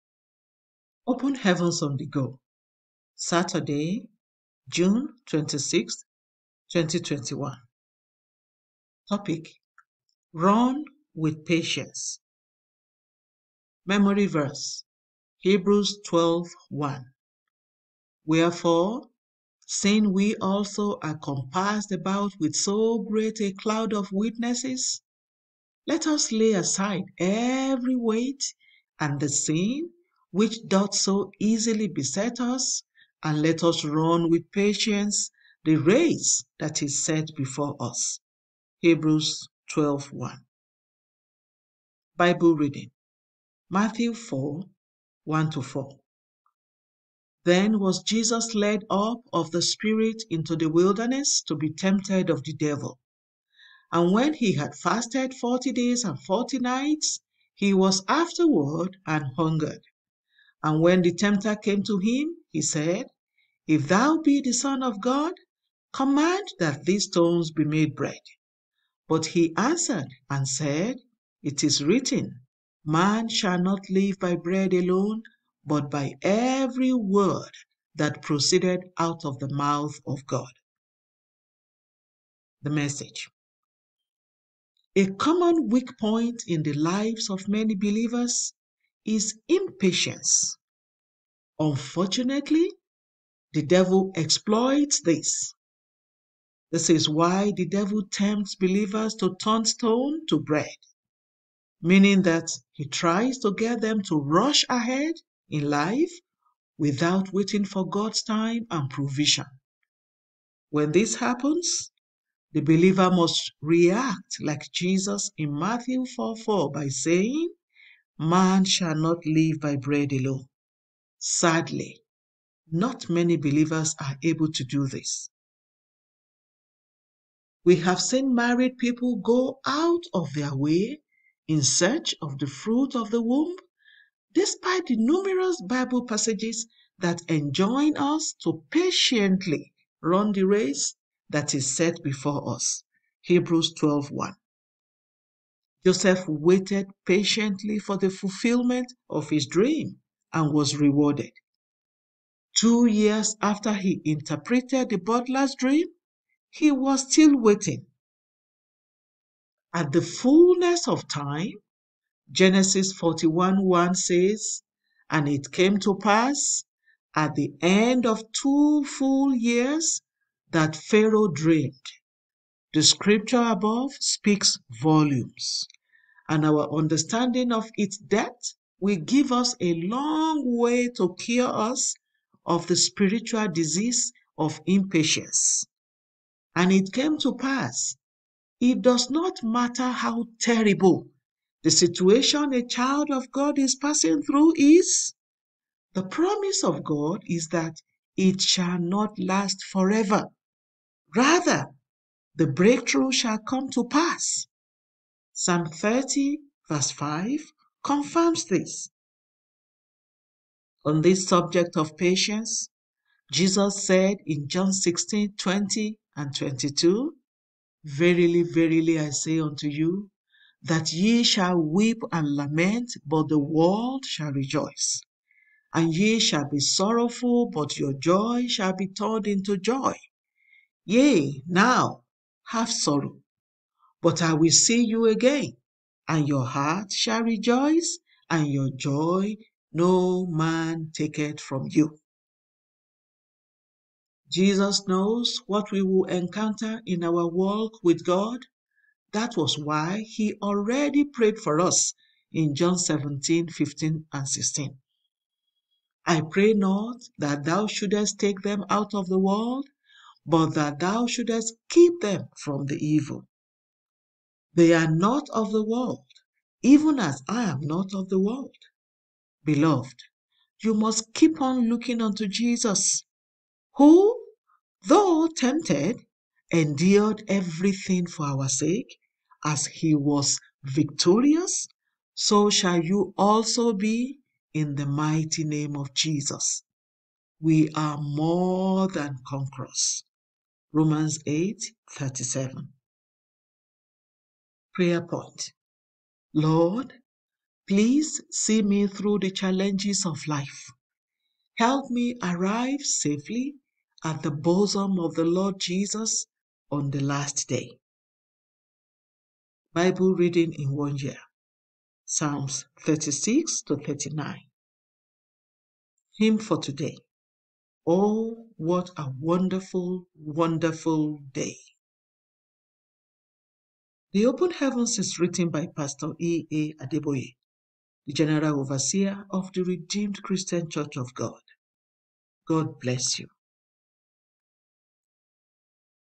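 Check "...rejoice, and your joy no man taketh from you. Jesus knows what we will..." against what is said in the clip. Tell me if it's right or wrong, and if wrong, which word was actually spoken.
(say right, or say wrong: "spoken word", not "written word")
right.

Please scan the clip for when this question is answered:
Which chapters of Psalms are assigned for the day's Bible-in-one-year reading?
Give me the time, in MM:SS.
05:12.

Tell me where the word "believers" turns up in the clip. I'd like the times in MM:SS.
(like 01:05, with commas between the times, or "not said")
01:27, 01:38, 01:52, 02:03.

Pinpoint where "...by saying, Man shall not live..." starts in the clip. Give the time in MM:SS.
01:56.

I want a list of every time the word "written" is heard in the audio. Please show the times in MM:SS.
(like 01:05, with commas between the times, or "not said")
01:11, 05:25.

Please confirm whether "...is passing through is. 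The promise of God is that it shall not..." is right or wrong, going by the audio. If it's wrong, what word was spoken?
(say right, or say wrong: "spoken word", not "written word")
right.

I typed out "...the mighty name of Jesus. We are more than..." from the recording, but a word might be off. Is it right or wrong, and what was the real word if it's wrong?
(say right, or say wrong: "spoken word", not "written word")
right.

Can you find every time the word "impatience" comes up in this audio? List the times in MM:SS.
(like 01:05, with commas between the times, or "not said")
01:29, 03:04.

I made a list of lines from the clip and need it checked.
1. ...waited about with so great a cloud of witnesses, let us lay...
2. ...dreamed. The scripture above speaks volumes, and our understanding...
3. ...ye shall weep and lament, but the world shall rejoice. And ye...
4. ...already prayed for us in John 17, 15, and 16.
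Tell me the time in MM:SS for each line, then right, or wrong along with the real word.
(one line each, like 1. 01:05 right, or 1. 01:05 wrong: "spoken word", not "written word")
1. 00:21 wrong: "compassed", not "waited"
2. 02:51 right
3. 03:40 right
4. 04:10 right.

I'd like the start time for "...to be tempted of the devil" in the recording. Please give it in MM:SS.
00:51.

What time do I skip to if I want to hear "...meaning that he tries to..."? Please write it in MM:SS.
01:41.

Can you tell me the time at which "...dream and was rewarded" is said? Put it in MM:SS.
02:29.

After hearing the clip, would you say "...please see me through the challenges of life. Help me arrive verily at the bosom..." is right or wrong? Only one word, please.
wrong.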